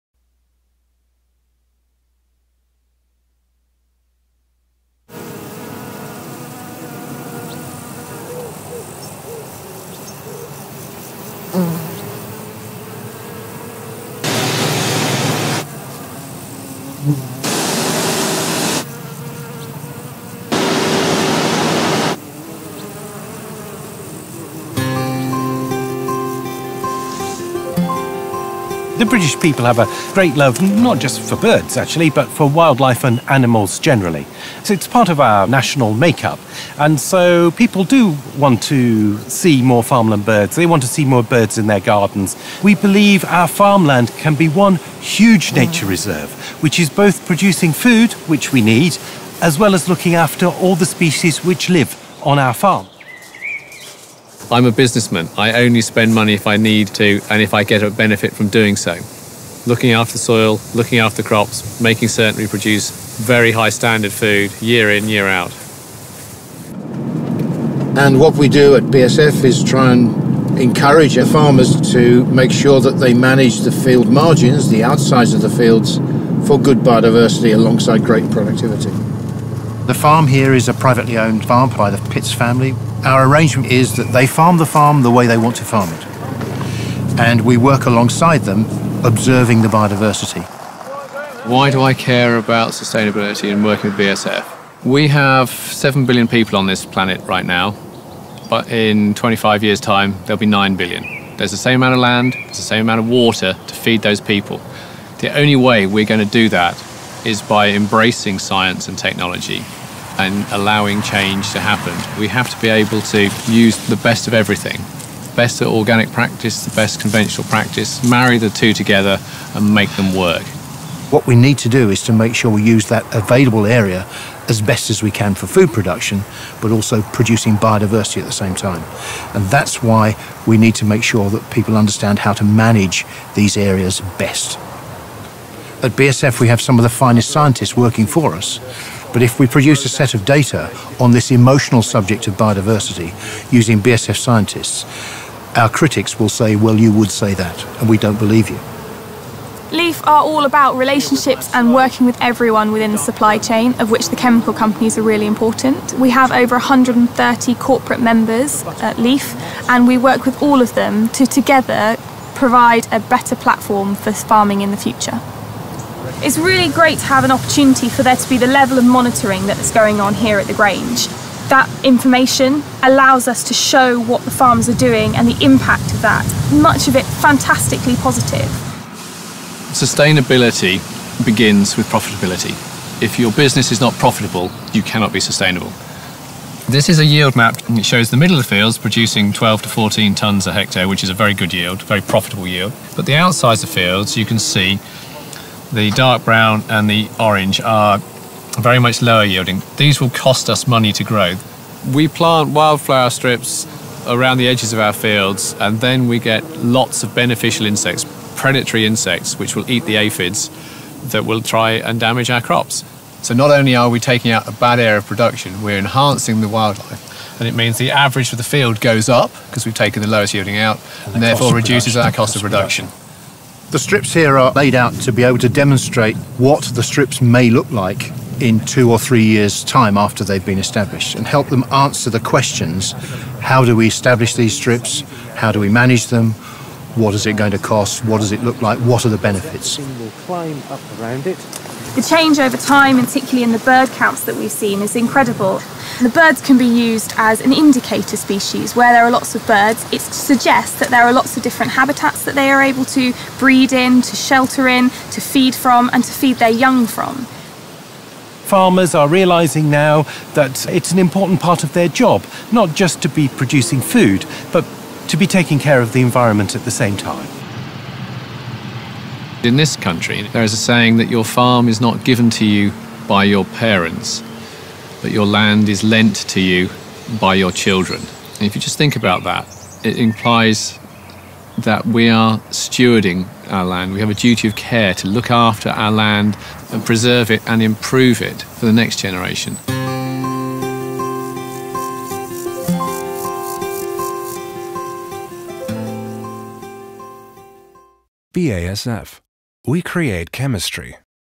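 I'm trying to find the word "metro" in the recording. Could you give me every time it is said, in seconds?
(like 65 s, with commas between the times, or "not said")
not said.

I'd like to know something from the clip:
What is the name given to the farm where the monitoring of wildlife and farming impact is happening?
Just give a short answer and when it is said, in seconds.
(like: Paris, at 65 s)
the Grange, at 170 s.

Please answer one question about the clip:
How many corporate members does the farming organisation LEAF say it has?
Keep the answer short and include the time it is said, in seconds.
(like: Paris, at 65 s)
over 130, at 156 s.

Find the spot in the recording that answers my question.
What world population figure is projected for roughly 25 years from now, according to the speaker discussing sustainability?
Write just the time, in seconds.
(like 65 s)
100 s.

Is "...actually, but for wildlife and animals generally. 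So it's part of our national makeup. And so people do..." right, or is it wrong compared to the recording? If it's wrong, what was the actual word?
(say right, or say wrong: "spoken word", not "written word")
right.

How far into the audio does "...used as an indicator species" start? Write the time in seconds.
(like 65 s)
246 s.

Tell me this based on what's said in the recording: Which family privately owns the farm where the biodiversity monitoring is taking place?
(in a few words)
Pitts.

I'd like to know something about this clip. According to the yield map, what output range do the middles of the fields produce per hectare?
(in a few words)
12 to 14 tonnes.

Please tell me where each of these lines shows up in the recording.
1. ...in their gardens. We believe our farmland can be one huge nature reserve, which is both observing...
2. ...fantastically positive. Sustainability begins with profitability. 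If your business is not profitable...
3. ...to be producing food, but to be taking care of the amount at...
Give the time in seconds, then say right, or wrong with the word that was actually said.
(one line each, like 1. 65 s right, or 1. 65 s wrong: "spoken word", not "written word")
1. 41 s wrong: "producing", not "observing"
2. 177 s right
3. 263 s wrong: "environment", not "amount".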